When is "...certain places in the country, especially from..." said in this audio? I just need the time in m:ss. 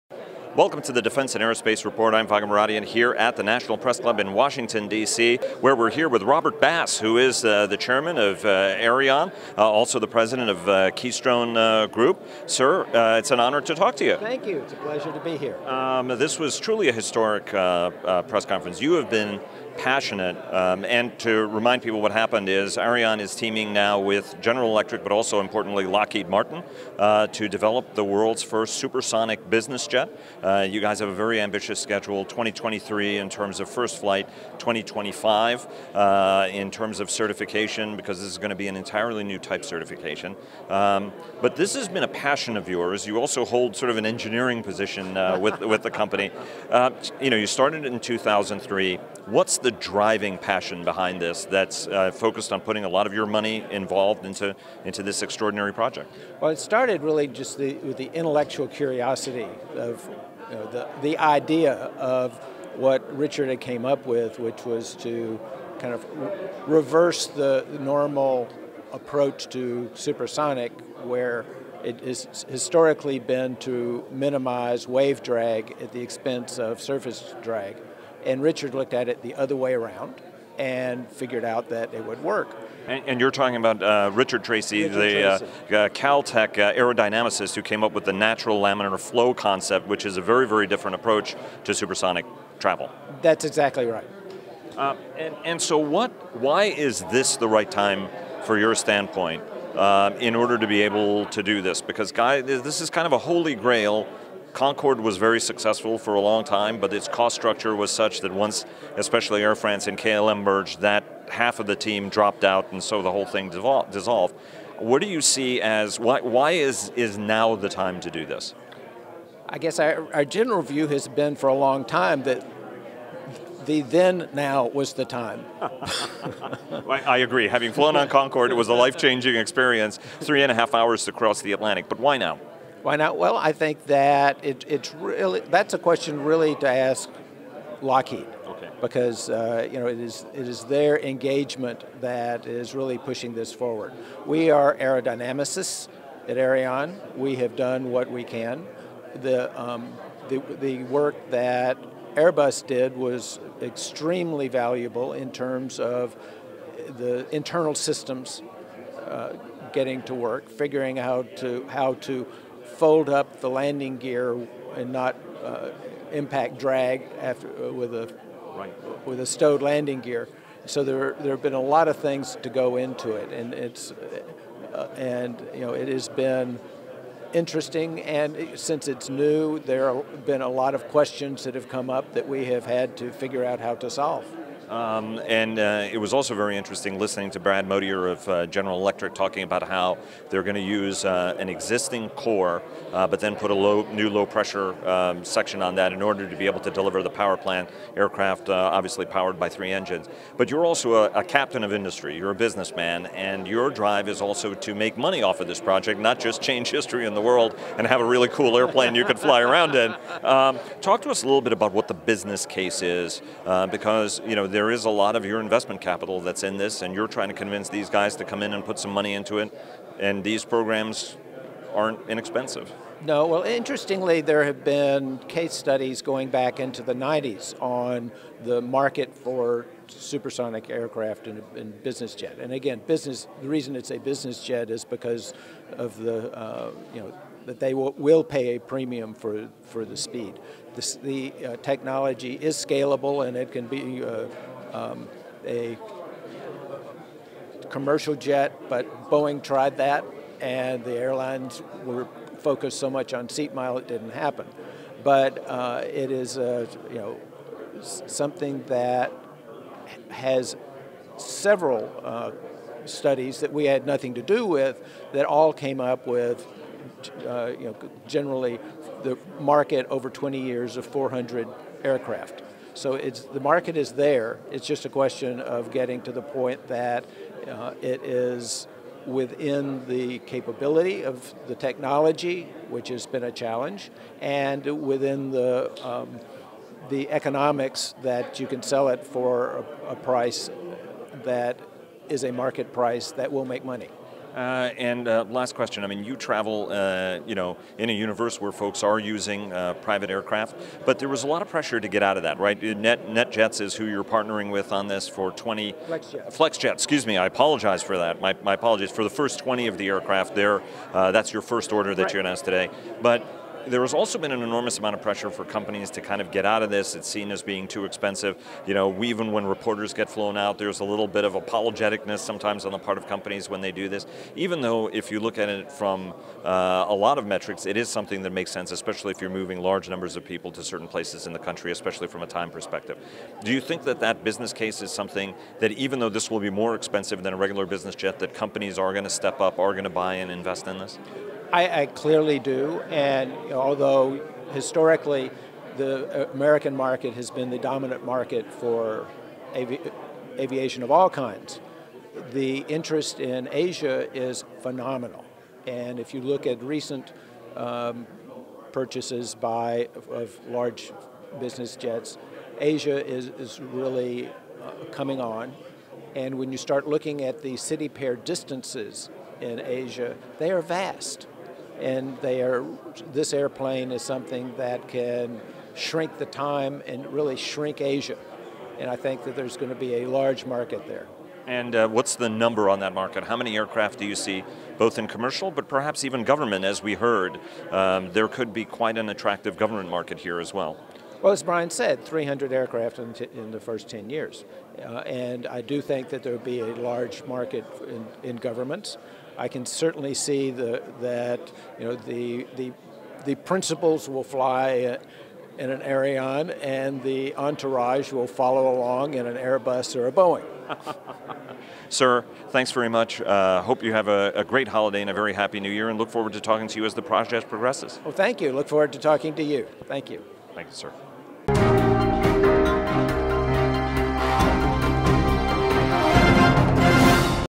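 5:30.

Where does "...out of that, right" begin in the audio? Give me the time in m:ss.
5:02.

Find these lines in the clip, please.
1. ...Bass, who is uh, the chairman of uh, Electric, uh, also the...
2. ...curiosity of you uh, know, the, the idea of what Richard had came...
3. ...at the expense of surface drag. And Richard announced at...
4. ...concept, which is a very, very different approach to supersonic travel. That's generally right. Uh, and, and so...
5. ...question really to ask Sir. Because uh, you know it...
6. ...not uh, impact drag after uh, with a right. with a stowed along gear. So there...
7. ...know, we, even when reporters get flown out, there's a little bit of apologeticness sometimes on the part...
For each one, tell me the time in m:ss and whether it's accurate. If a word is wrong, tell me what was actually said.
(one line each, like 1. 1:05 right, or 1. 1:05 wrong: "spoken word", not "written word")
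1. 0:06 wrong: "Aerion", not "Electric"
2. 0:58 right
3. 1:15 wrong: "looked", not "announced"
4. 1:29 wrong: "exactly", not "generally"
5. 2:15 wrong: "Lockheed", not "Sir"
6. 2:44 wrong: "landing", not "along"
7. 5:18 right.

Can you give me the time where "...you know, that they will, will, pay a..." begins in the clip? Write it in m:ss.
3:56.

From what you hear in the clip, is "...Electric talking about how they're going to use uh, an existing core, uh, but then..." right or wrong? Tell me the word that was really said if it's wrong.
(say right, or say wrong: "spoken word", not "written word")
right.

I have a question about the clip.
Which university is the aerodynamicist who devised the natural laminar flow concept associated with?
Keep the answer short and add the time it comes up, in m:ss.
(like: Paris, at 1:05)
Caltech, at 1:25.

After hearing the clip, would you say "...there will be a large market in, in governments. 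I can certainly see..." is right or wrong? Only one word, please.
right.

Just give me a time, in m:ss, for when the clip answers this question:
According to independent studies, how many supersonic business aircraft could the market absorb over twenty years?
4:30.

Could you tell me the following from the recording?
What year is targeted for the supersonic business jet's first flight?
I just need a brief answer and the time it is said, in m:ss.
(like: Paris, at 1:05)
2023, at 0:32.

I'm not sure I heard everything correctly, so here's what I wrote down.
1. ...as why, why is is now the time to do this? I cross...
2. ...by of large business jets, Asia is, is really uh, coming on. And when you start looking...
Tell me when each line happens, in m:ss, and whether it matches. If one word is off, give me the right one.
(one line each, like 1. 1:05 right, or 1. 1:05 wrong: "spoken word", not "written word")
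1. 1:55 wrong: "guess", not "cross"
2. 5:59 right.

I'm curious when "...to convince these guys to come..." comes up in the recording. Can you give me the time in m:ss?
3:37.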